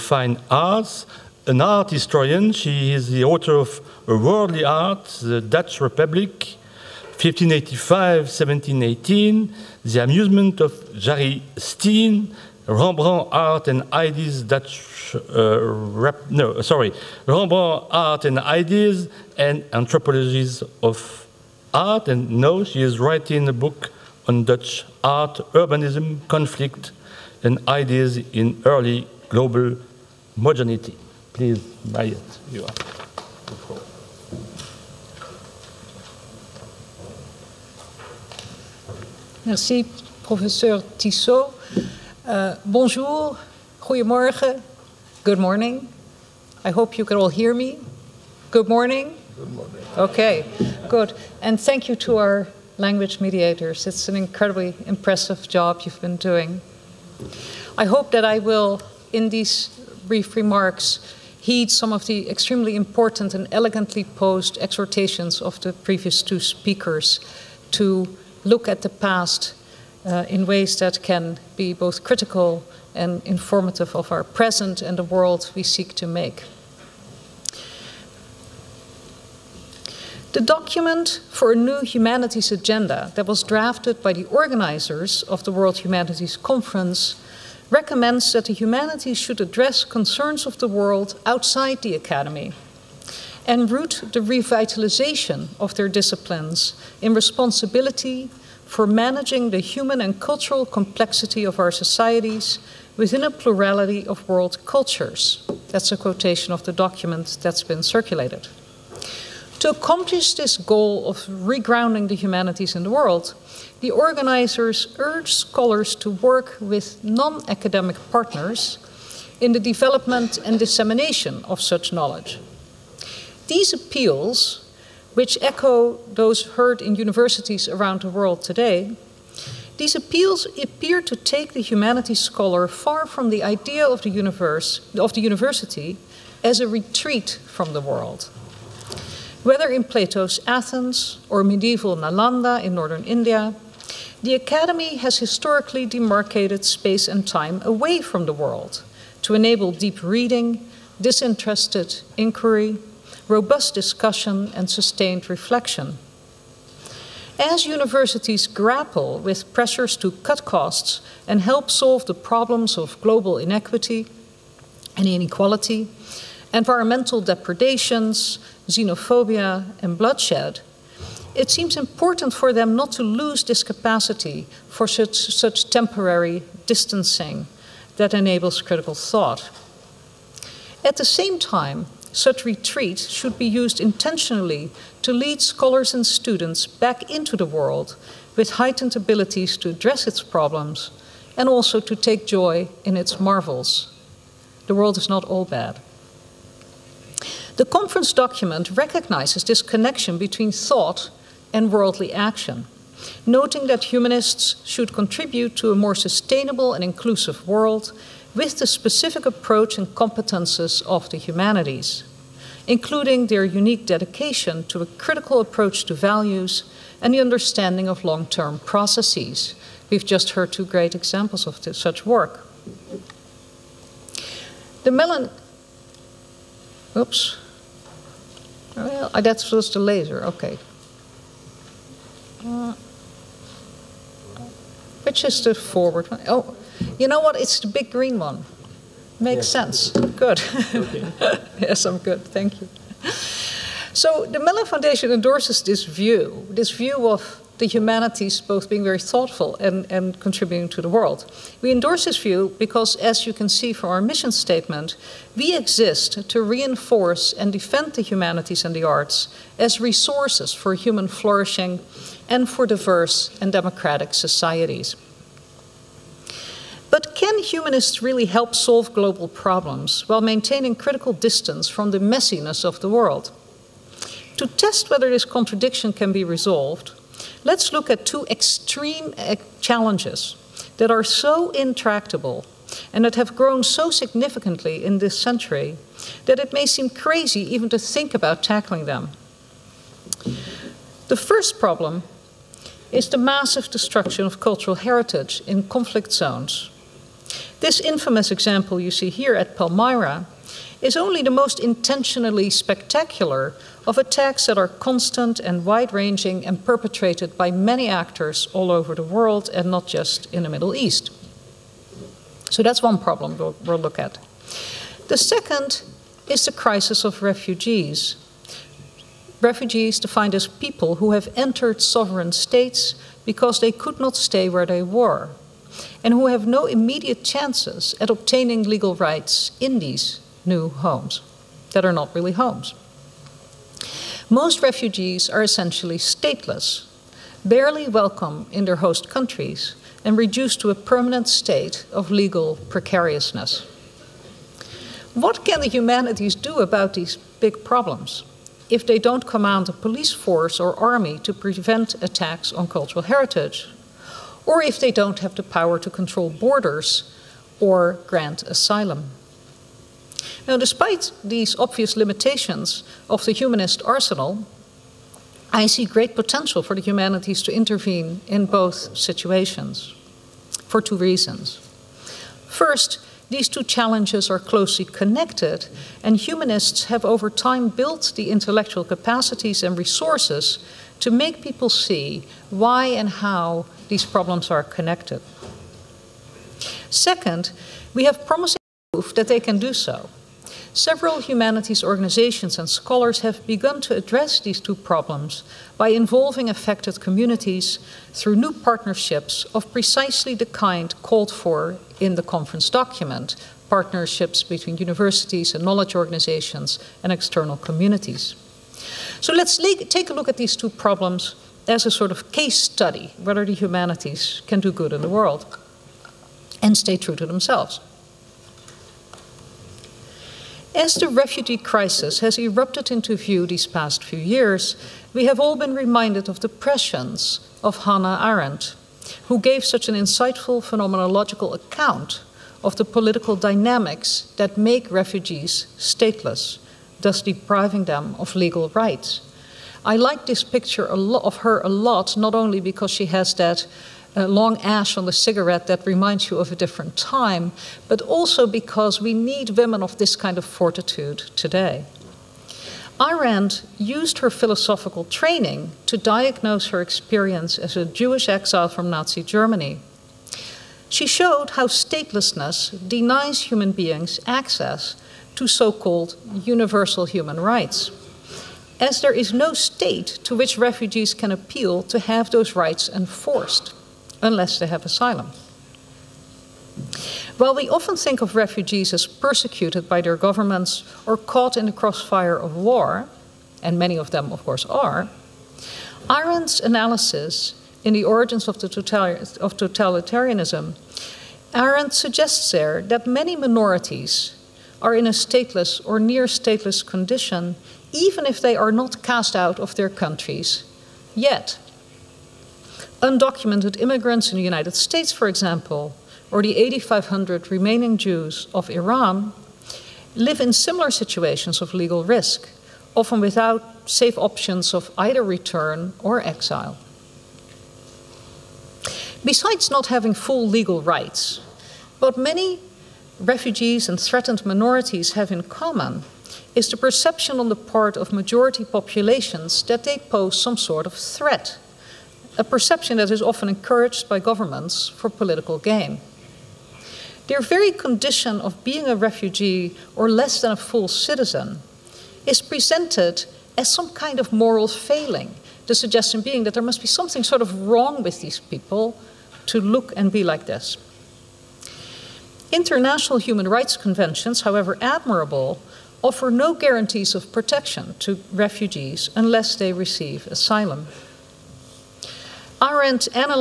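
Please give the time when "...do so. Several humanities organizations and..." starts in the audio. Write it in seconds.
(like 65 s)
389 s.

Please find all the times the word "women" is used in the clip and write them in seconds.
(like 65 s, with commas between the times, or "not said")
449 s.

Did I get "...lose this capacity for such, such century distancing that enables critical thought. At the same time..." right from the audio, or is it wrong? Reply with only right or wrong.
wrong.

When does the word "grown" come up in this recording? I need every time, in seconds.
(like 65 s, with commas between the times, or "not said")
283 s.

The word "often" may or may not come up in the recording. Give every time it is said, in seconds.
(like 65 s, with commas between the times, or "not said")
477 s, 512 s, 533 s.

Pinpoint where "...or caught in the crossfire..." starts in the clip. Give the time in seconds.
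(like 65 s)
481 s.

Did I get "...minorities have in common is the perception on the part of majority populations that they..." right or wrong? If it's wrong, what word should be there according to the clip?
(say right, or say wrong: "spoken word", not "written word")
right.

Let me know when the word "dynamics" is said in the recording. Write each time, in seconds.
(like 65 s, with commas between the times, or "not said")
433 s.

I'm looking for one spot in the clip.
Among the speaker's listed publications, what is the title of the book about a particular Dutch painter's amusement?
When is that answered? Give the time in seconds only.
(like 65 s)
9 s.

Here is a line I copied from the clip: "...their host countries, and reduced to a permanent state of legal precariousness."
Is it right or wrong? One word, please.
right.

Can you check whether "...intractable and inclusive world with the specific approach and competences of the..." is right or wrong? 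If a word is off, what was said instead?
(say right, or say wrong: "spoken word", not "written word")
wrong: "sustainable", not "intractable".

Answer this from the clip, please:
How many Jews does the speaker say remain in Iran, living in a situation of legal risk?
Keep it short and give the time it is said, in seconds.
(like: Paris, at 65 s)
8,500, at 506 s.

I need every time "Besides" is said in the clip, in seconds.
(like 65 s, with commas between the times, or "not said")
519 s.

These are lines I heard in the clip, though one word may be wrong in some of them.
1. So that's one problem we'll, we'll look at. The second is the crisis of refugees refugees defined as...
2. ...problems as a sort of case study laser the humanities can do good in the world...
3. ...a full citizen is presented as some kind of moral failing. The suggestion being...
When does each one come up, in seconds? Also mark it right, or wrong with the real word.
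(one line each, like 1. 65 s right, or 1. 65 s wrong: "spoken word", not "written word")
1. 312 s right
2. 410 s wrong: "whether", not "laser"
3. 540 s right.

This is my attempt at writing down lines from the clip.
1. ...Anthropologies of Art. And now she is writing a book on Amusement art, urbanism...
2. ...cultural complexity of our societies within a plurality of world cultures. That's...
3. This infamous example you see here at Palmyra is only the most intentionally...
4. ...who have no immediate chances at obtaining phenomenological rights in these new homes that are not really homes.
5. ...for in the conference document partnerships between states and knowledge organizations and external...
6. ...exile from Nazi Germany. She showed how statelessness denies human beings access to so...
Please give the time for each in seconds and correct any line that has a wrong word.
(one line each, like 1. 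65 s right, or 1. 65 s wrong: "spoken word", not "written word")
1. 19 s wrong: "Dutch", not "Amusement"
2. 100 s right
3. 297 s right
4. 326 s wrong: "legal", not "phenomenological"
5. 401 s wrong: "universities", not "states"
6. 458 s right.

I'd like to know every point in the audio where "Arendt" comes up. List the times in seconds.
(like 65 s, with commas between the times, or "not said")
428 s, 453 s, 486 s, 491 s, 562 s.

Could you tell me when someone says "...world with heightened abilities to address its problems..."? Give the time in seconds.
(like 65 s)
187 s.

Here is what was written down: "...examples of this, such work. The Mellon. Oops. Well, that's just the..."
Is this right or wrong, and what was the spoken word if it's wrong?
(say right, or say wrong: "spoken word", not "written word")
right.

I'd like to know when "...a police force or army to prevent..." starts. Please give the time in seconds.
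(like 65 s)
349 s.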